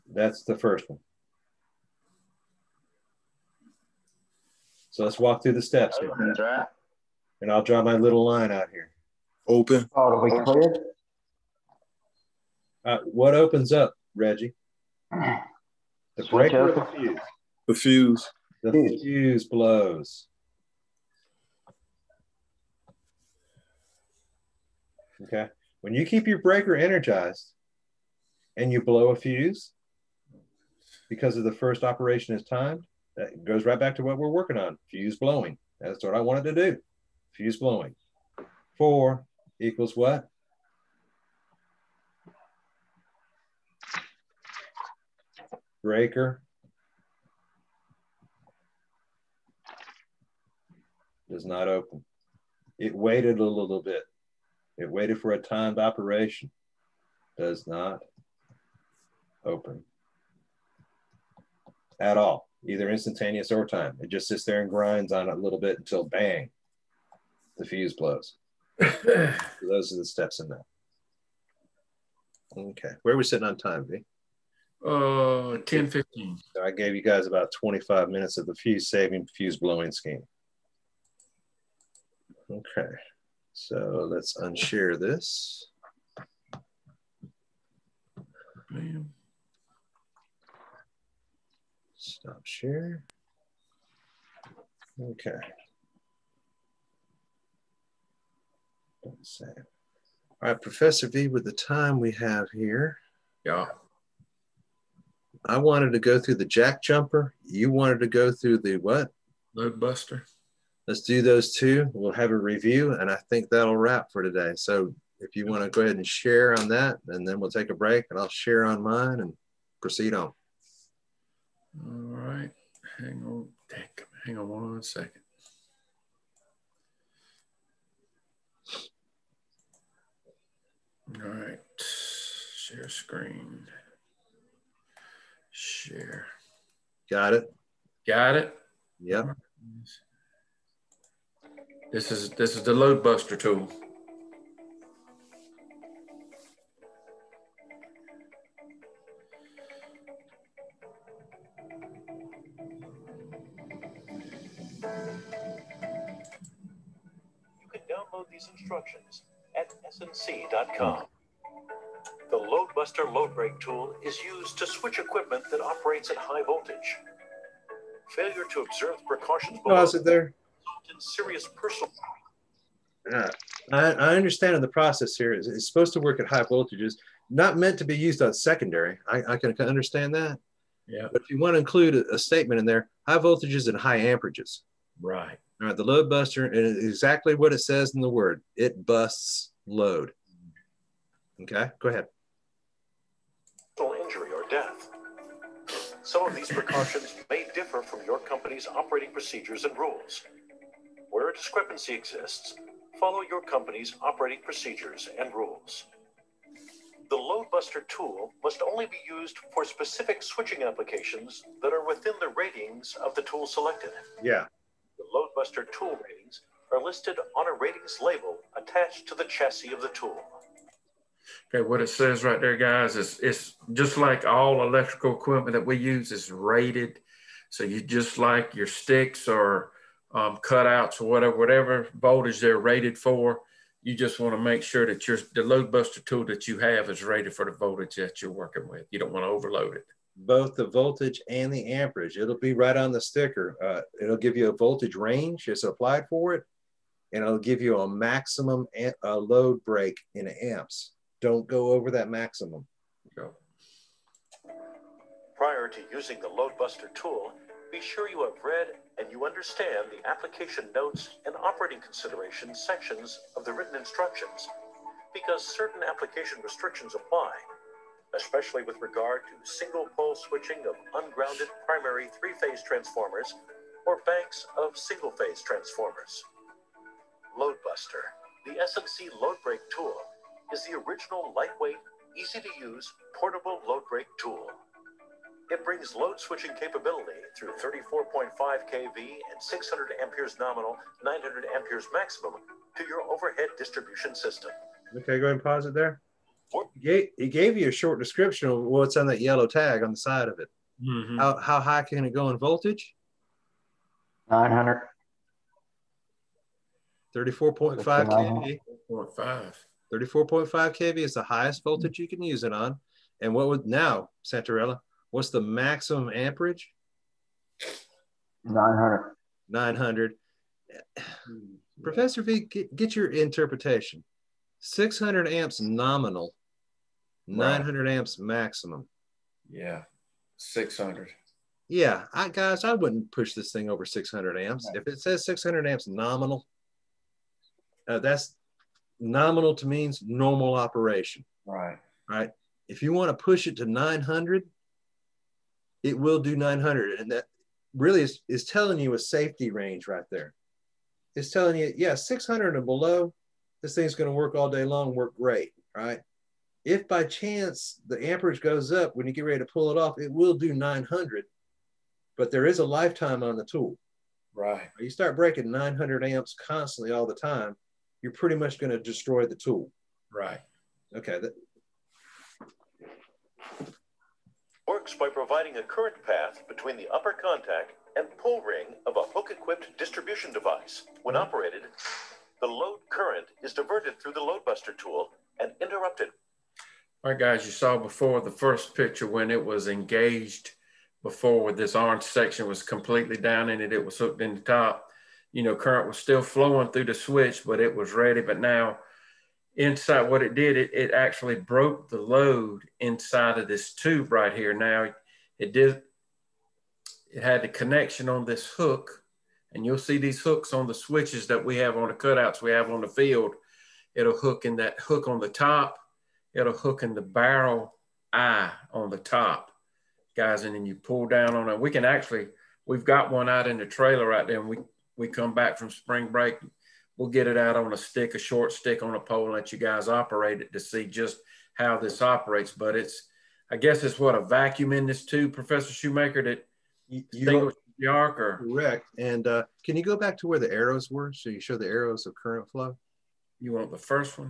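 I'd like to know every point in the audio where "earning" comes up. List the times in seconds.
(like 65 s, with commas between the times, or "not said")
not said.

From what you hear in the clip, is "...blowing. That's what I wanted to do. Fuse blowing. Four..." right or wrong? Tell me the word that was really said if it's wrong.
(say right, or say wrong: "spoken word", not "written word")
right.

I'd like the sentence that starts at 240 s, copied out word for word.
Both the voltage and the amperage.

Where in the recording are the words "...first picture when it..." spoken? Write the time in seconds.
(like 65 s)
388 s.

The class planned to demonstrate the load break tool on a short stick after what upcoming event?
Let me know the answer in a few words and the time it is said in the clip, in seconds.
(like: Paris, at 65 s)
Spring break, at 425 s.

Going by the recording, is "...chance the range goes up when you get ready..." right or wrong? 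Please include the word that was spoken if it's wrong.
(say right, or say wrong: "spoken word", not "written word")
wrong: "amperage", not "range".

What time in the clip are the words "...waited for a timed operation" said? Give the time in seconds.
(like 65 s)
54 s.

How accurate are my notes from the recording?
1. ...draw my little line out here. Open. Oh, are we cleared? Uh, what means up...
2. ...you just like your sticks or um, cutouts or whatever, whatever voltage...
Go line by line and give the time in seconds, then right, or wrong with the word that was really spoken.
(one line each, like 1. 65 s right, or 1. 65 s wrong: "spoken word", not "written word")
1. 7 s wrong: "opens", not "means"
2. 227 s right.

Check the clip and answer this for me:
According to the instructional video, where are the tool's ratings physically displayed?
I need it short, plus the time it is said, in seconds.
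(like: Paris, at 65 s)
A ratings label, at 217 s.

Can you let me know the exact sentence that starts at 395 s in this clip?
You know, current was still flowing through the switch, but it was ready.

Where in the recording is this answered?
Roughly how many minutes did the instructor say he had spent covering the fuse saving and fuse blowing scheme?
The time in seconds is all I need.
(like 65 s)
77 s.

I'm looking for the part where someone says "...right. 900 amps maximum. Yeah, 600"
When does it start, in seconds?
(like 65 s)
327 s.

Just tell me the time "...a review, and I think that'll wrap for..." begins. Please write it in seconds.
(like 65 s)
112 s.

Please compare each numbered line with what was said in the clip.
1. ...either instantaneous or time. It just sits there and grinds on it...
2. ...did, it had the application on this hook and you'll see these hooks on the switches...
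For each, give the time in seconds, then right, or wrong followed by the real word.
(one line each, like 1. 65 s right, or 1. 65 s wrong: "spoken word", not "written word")
1. 62 s right
2. 405 s wrong: "connection", not "application".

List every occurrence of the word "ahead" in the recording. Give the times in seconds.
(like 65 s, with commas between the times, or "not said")
115 s, 191 s, 295 s.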